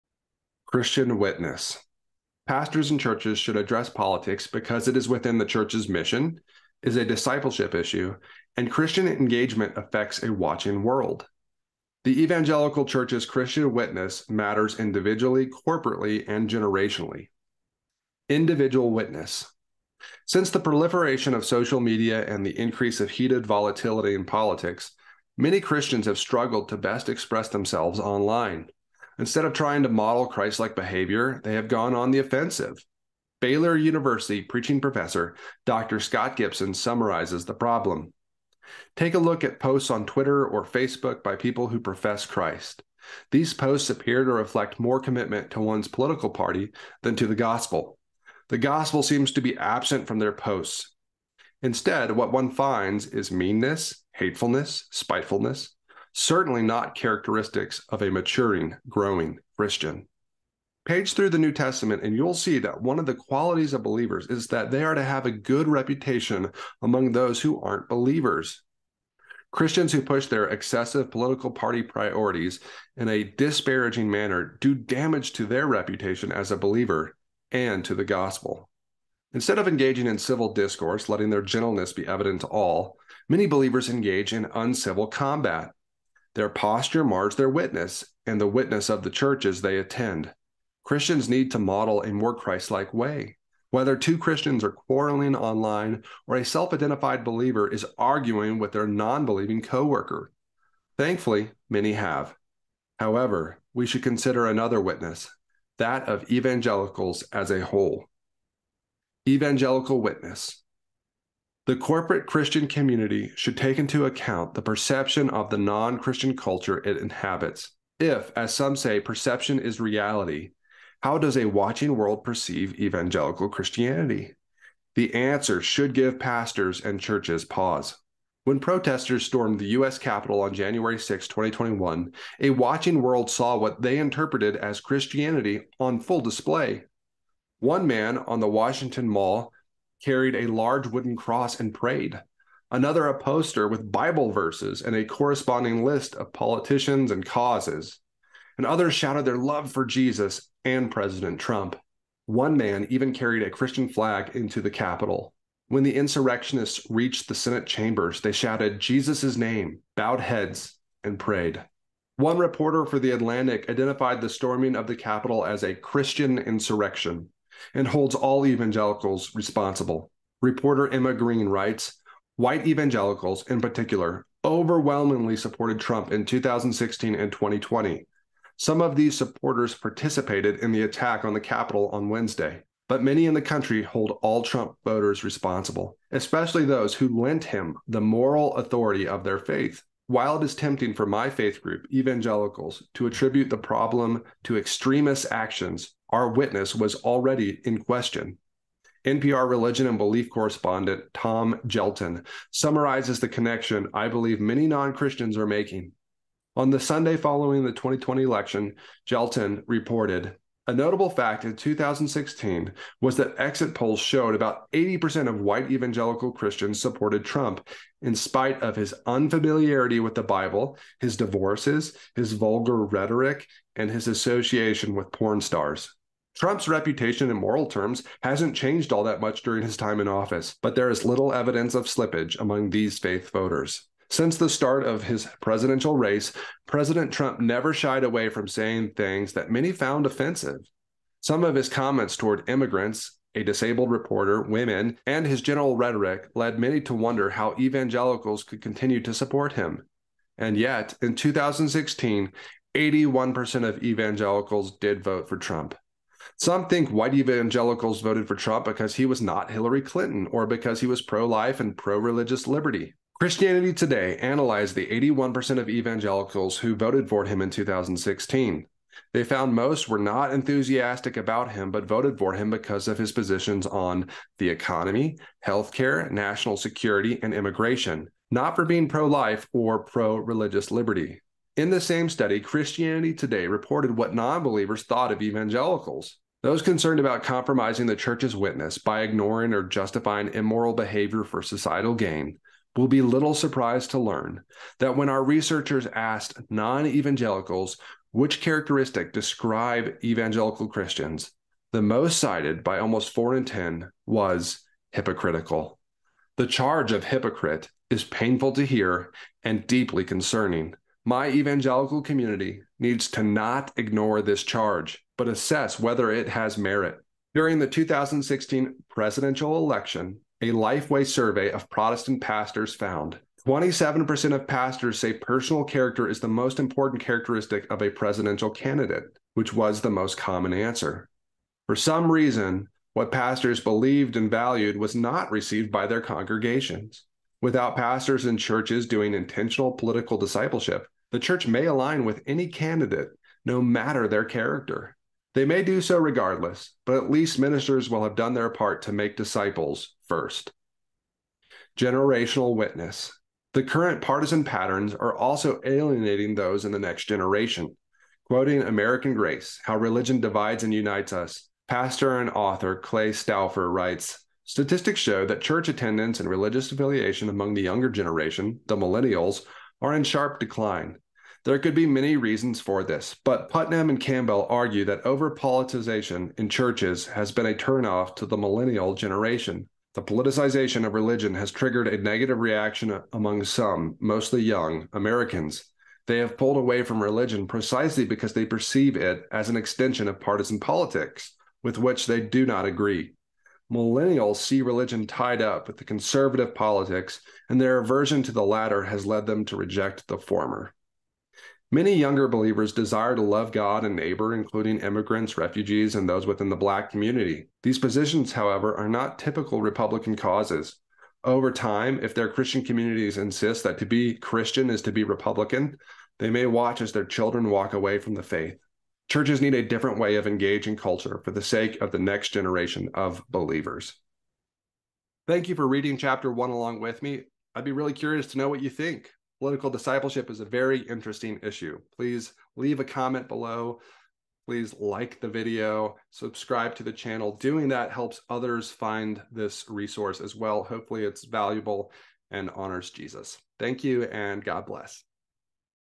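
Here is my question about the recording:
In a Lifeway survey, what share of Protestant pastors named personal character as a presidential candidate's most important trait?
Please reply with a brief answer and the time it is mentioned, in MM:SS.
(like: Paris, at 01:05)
27%, at 05:23.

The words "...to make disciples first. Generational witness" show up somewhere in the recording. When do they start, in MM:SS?
05:48.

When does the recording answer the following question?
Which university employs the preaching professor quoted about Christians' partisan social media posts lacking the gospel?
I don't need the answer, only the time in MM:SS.
00:33.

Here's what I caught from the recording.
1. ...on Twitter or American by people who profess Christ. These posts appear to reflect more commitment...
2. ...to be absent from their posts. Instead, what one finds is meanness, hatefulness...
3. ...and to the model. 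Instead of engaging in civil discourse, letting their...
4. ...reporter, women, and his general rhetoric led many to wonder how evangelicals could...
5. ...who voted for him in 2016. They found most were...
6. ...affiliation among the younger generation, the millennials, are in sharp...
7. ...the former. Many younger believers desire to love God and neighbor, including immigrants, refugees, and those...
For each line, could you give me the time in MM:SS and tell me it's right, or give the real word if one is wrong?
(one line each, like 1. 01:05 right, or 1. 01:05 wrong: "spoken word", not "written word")
1. 00:39 wrong: "Facebook", not "American"
2. 00:49 right
3. 01:17 wrong: "gospel", not "model"
4. 04:03 right
5. 04:26 right
6. 06:06 right
7. 06:40 right.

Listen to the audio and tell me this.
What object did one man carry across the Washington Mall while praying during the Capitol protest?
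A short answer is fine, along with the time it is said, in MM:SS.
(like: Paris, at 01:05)
A large wooden cross, at 02:20.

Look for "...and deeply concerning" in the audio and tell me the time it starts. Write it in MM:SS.
05:09.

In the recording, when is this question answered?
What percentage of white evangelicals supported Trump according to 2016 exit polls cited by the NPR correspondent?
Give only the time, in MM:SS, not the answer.
03:34.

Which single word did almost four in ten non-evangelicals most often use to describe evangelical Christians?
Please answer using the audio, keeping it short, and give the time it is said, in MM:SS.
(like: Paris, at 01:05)
Hypocritical, at 05:04.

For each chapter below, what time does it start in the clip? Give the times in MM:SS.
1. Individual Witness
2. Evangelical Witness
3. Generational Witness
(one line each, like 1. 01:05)
1. 00:18
2. 01:49
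3. 05:50.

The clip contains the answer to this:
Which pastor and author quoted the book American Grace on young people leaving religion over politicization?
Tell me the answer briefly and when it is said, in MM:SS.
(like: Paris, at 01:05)
Clay Stauffer, at 06:02.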